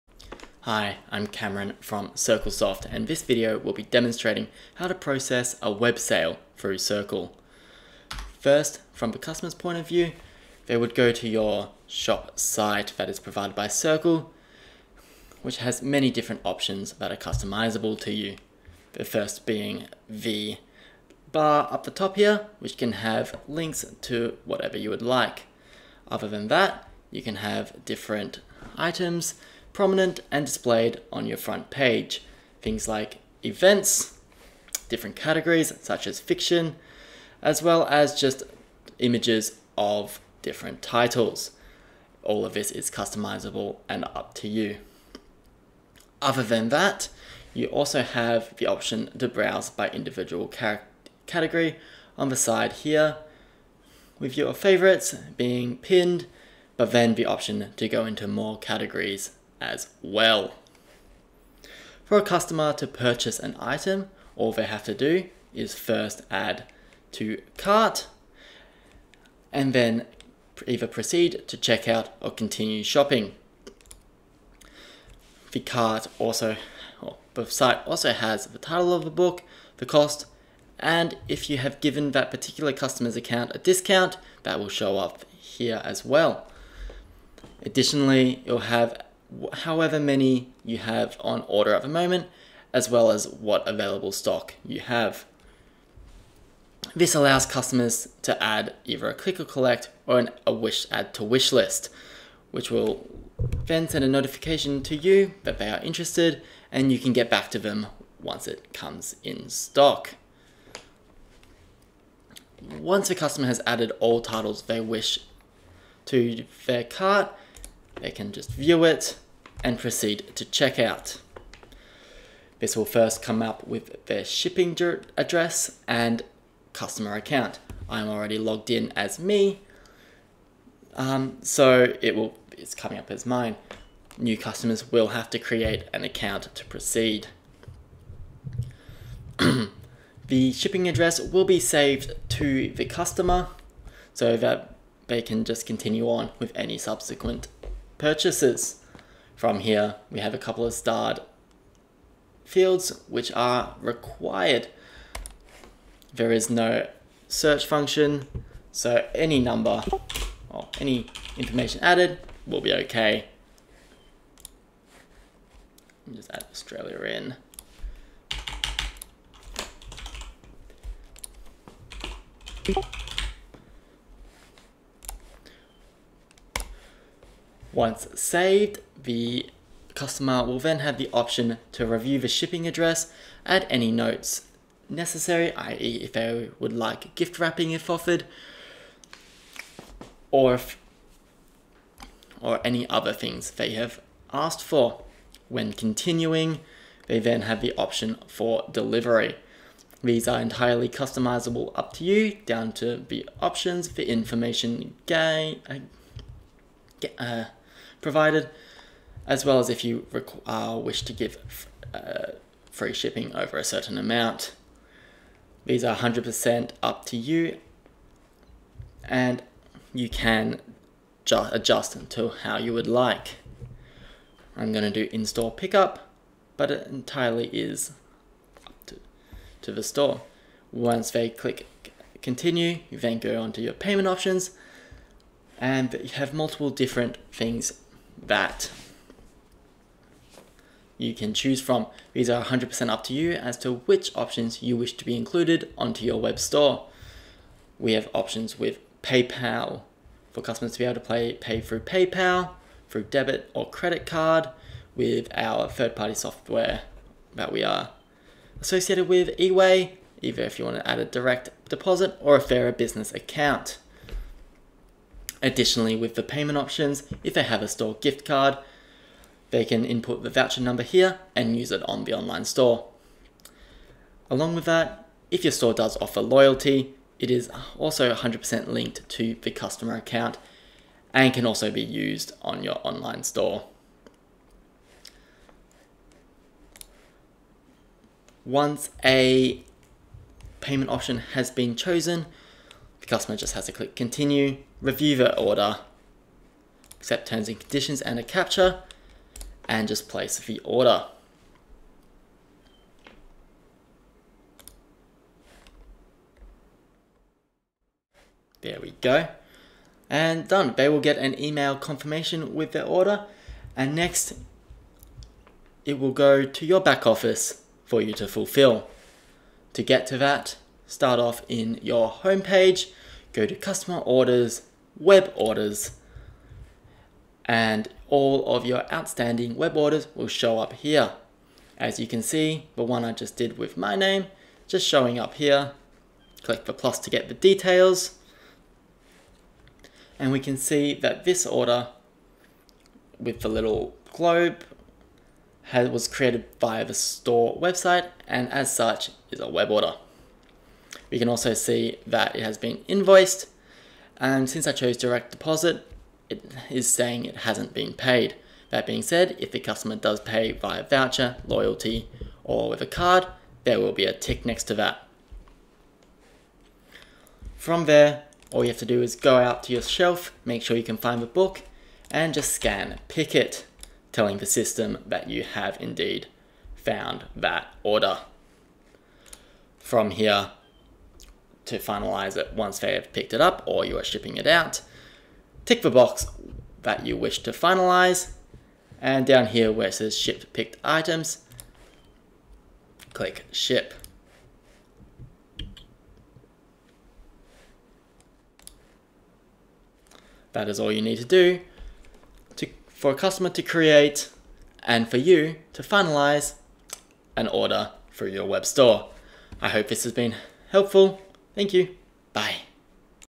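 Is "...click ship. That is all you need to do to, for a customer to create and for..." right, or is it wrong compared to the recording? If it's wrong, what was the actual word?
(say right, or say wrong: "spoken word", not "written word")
right.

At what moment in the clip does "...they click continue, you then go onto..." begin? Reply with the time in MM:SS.
03:51.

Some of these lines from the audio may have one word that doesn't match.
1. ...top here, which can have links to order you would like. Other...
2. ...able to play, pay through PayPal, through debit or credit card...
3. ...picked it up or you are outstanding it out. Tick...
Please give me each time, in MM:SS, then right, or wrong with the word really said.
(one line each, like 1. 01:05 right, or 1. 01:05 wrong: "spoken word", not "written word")
1. 00:21 wrong: "whatever", not "order"
2. 04:10 right
3. 06:23 wrong: "shipping", not "outstanding".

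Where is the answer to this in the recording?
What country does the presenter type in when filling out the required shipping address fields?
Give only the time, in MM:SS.
02:46.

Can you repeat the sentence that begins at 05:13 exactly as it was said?
And next, it will go to your back office for you to fulfill.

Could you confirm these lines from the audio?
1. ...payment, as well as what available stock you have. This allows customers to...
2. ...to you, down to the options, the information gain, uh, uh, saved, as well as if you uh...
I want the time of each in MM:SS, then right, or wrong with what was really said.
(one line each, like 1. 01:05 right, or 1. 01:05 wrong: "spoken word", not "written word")
1. 01:31 wrong: "moment", not "payment"
2. 03:21 wrong: "provided", not "saved".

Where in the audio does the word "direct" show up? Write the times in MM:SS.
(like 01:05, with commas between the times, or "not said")
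04:21, 05:54.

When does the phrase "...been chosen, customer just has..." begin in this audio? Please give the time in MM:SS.
04:51.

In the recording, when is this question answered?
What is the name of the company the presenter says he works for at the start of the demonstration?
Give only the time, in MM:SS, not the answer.
00:02.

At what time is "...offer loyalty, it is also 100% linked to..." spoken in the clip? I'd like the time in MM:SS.
04:35.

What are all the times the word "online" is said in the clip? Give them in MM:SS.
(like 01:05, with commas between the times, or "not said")
04:32, 04:42.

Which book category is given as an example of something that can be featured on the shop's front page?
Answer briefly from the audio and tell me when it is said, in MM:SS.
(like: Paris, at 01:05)
Fiction, at 00:36.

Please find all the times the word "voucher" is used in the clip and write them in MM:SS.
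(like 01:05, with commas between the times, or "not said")
04:30, 06:00.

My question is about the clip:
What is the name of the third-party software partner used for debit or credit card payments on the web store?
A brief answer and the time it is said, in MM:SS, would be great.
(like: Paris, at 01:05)
eWay, at 04:19.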